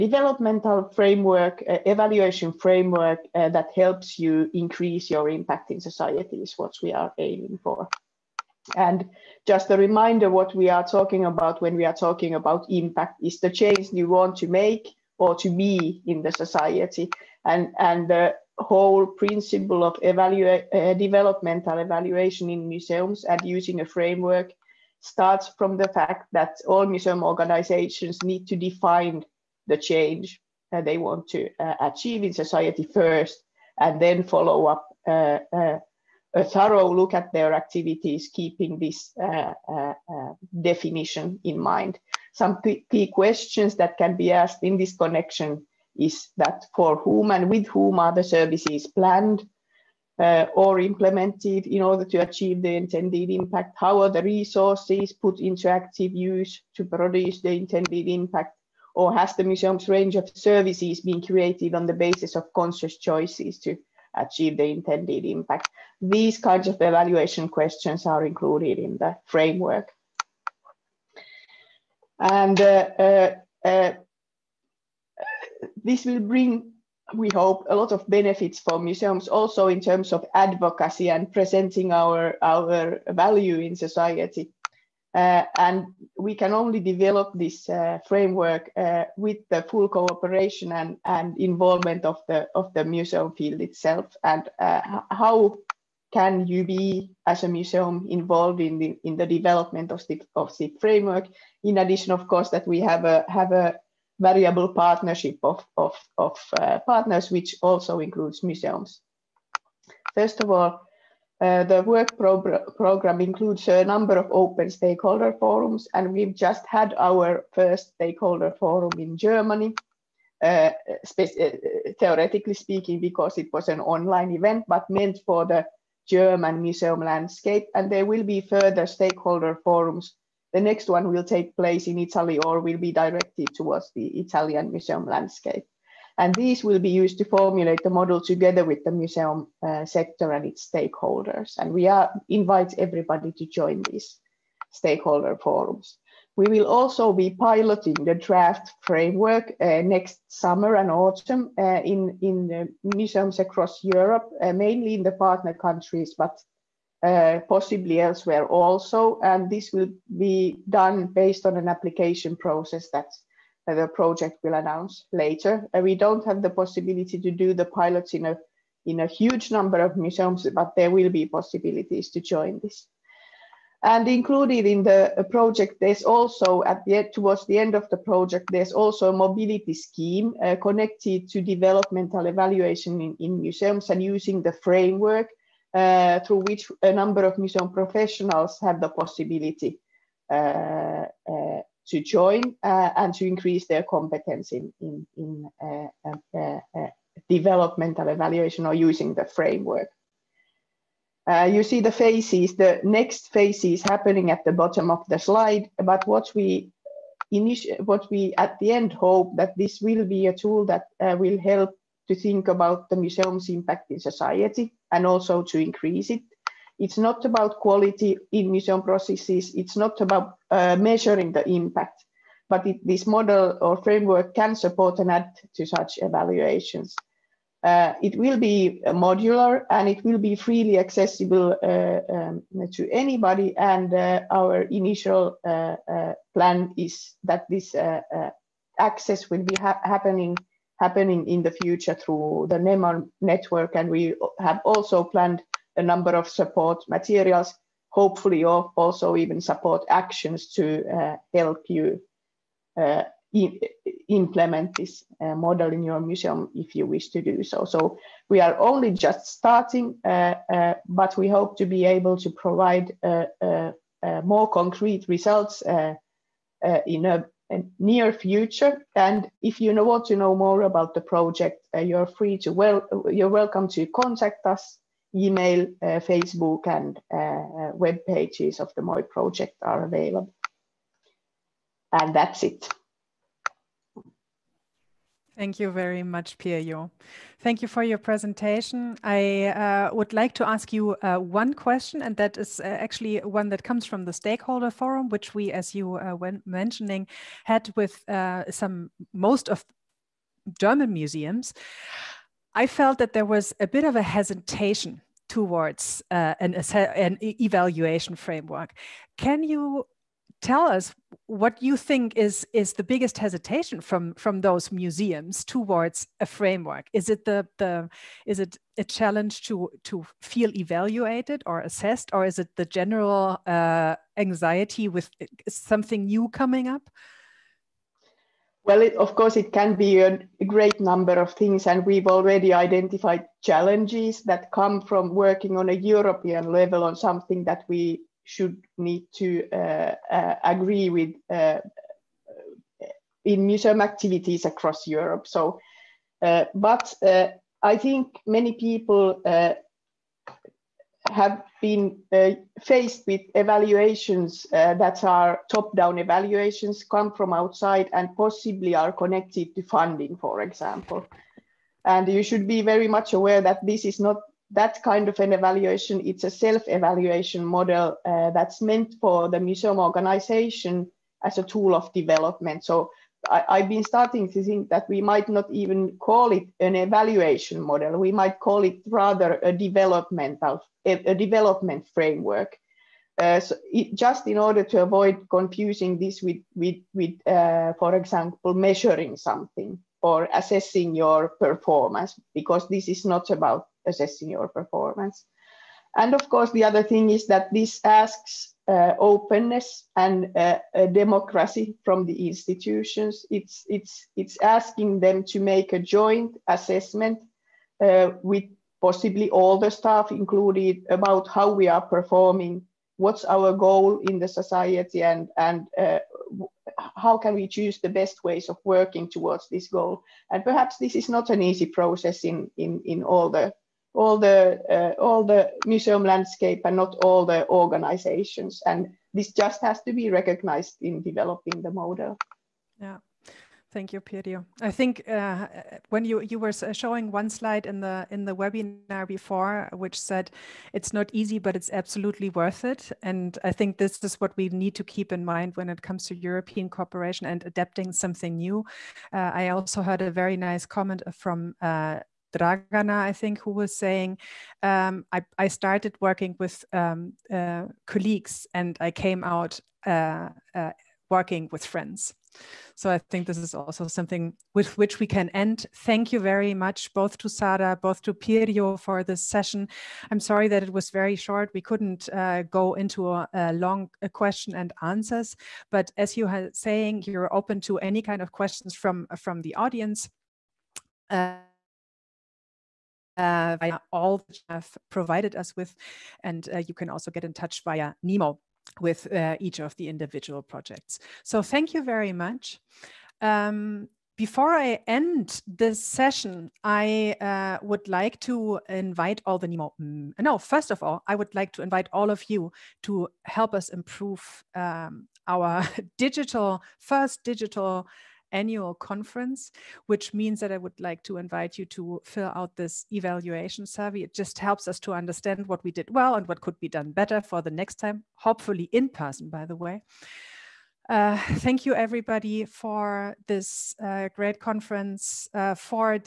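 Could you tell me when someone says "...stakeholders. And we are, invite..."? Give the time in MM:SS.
02:20.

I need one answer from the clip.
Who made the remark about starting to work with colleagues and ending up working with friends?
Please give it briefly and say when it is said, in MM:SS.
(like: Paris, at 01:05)
Dragana, at 07:32.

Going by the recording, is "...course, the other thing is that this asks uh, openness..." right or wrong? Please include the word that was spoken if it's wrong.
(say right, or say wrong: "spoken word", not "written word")
right.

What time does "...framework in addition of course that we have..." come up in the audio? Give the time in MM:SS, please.
01:40.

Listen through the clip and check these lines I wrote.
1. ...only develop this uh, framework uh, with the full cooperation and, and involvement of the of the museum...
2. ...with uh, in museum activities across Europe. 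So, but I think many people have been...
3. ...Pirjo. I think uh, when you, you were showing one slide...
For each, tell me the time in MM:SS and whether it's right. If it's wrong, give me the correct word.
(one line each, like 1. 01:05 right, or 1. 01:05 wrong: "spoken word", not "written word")
1. 01:26 right
2. 05:40 right
3. 07:14 right.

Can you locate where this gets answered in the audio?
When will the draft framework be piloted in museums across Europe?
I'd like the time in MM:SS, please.
02:29.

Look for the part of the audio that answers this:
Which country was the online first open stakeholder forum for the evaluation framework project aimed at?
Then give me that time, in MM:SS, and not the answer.
01:59.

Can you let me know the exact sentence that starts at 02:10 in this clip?
The next one will take place in Italy or will be directed towards the Italian museum landscape.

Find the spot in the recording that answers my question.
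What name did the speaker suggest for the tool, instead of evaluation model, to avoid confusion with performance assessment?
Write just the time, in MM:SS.
06:21.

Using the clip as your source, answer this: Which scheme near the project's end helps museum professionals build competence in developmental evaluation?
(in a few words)
mobility scheme.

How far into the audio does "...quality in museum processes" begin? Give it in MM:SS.
03:37.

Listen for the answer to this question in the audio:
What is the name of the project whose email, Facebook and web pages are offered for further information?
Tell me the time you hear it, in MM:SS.
04:38.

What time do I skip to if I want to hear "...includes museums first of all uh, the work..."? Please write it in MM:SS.
01:47.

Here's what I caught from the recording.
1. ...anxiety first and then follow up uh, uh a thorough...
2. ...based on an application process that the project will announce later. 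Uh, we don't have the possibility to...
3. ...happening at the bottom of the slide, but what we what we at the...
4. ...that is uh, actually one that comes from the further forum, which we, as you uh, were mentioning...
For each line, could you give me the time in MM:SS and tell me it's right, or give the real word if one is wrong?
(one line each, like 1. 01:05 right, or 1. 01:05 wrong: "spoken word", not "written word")
1. 00:32 wrong: "society", not "anxiety"
2. 02:41 right
3. 03:23 right
4. 04:52 wrong: "stakeholder", not "further".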